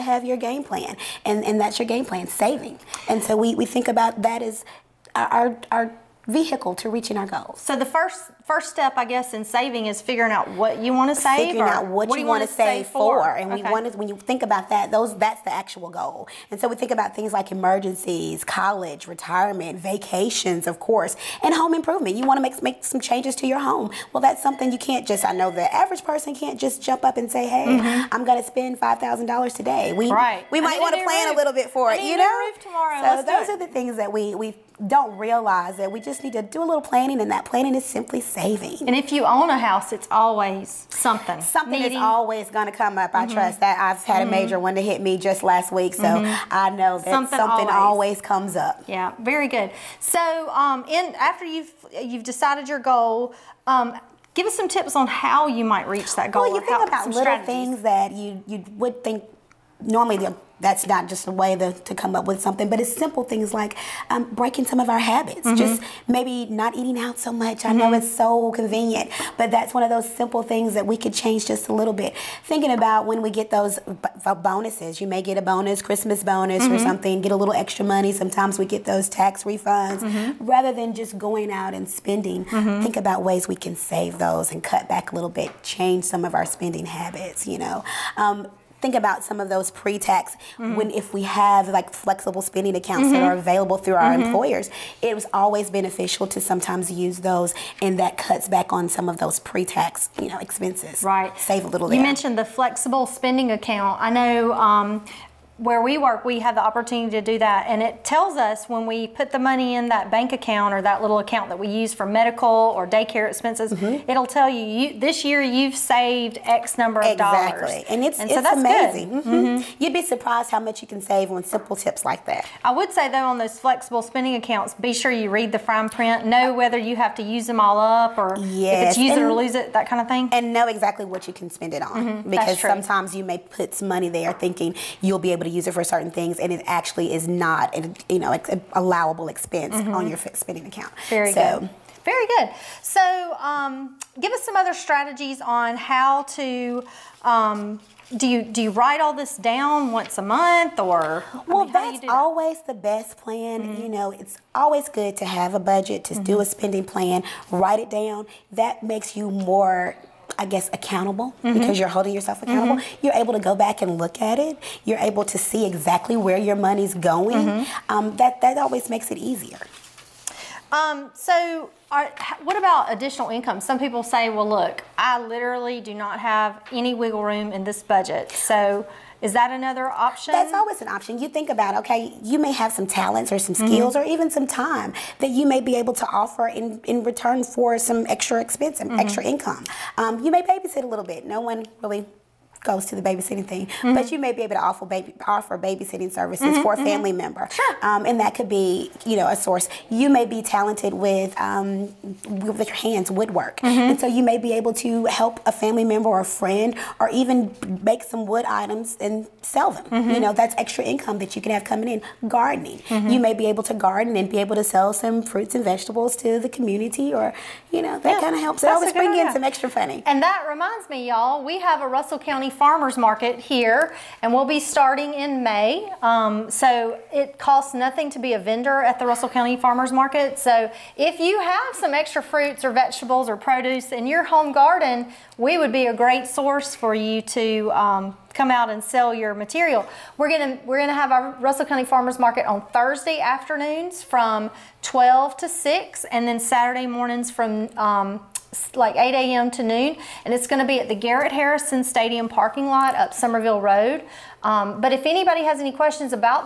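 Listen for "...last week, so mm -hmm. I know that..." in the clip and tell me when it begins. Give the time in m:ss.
0:45.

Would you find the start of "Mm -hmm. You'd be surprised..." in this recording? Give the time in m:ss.
1:59.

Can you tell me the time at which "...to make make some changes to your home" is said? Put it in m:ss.
0:22.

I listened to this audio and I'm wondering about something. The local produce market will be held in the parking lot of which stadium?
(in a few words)
Garrett Harrison Stadium.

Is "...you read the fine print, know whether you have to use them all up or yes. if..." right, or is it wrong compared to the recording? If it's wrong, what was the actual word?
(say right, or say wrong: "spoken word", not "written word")
right.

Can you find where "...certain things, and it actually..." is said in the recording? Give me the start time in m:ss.
2:15.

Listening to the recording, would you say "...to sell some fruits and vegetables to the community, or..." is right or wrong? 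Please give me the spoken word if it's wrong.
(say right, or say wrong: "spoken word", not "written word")
right.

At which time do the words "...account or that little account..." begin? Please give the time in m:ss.
1:50.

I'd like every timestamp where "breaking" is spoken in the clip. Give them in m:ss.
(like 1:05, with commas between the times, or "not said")
1:04.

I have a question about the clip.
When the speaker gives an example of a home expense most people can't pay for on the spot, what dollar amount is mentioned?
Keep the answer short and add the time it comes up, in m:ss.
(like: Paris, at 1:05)
$5,000, at 0:28.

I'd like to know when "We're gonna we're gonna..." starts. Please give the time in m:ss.
4:00.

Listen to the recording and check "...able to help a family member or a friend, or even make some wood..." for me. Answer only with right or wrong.
right.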